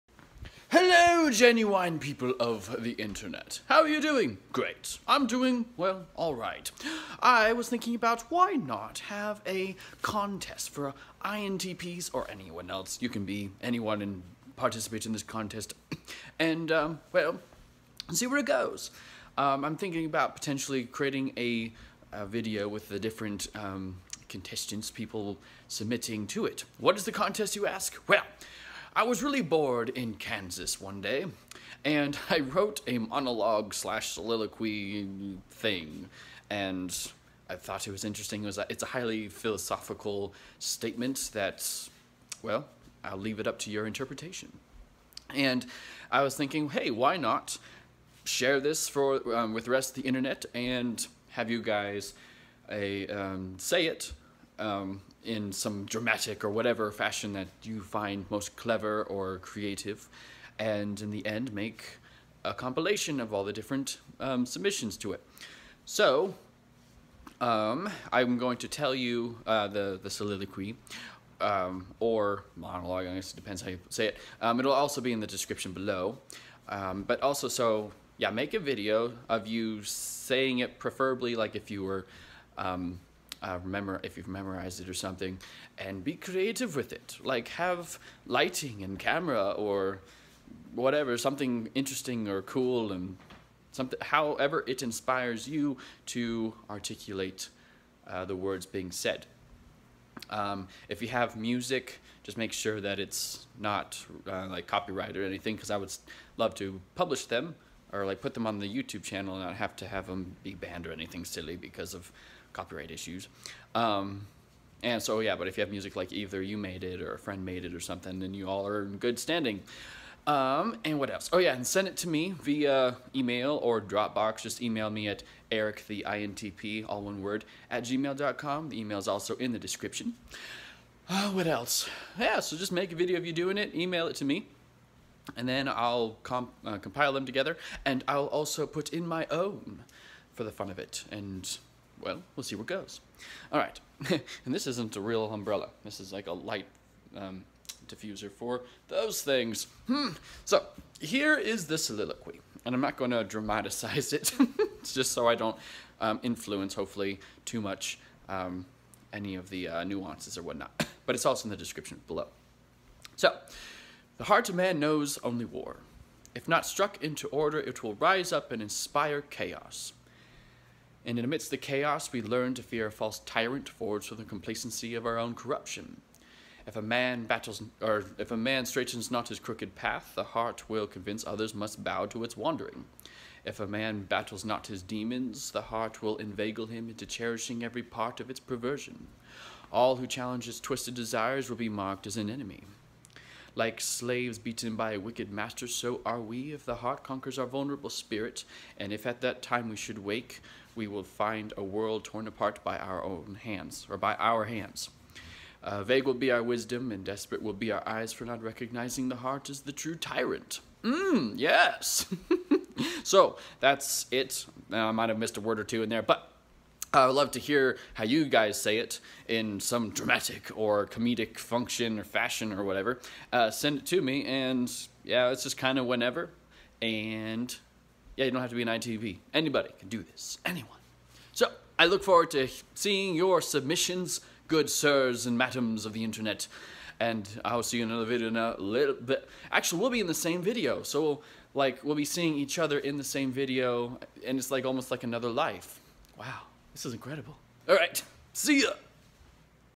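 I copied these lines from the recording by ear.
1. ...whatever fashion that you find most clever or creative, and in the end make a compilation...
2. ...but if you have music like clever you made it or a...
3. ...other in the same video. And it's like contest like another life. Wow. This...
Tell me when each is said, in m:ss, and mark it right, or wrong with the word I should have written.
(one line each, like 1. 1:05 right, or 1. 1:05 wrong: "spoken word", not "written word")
1. 0:56 right
2. 1:55 wrong: "either", not "clever"
3. 4:02 wrong: "almost", not "contest".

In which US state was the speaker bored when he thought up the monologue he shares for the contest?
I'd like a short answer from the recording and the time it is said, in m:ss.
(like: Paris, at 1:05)
Kansas, at 0:30.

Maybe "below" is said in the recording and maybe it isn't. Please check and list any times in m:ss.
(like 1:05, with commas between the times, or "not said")
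1:15, 2:42.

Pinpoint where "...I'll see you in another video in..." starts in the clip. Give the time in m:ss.
3:57.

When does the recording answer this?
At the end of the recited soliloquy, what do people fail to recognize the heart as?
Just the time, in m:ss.
3:29.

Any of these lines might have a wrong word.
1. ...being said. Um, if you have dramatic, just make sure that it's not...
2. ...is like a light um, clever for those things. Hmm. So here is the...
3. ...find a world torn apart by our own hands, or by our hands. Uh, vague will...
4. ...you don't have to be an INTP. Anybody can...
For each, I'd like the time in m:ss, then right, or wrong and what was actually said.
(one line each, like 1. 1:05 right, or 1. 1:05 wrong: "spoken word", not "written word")
1. 1:38 wrong: "music", not "dramatic"
2. 2:25 wrong: "diffuser", not "clever"
3. 3:21 right
4. 3:48 right.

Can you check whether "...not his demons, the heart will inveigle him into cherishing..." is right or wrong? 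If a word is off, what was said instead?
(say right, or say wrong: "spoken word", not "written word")
right.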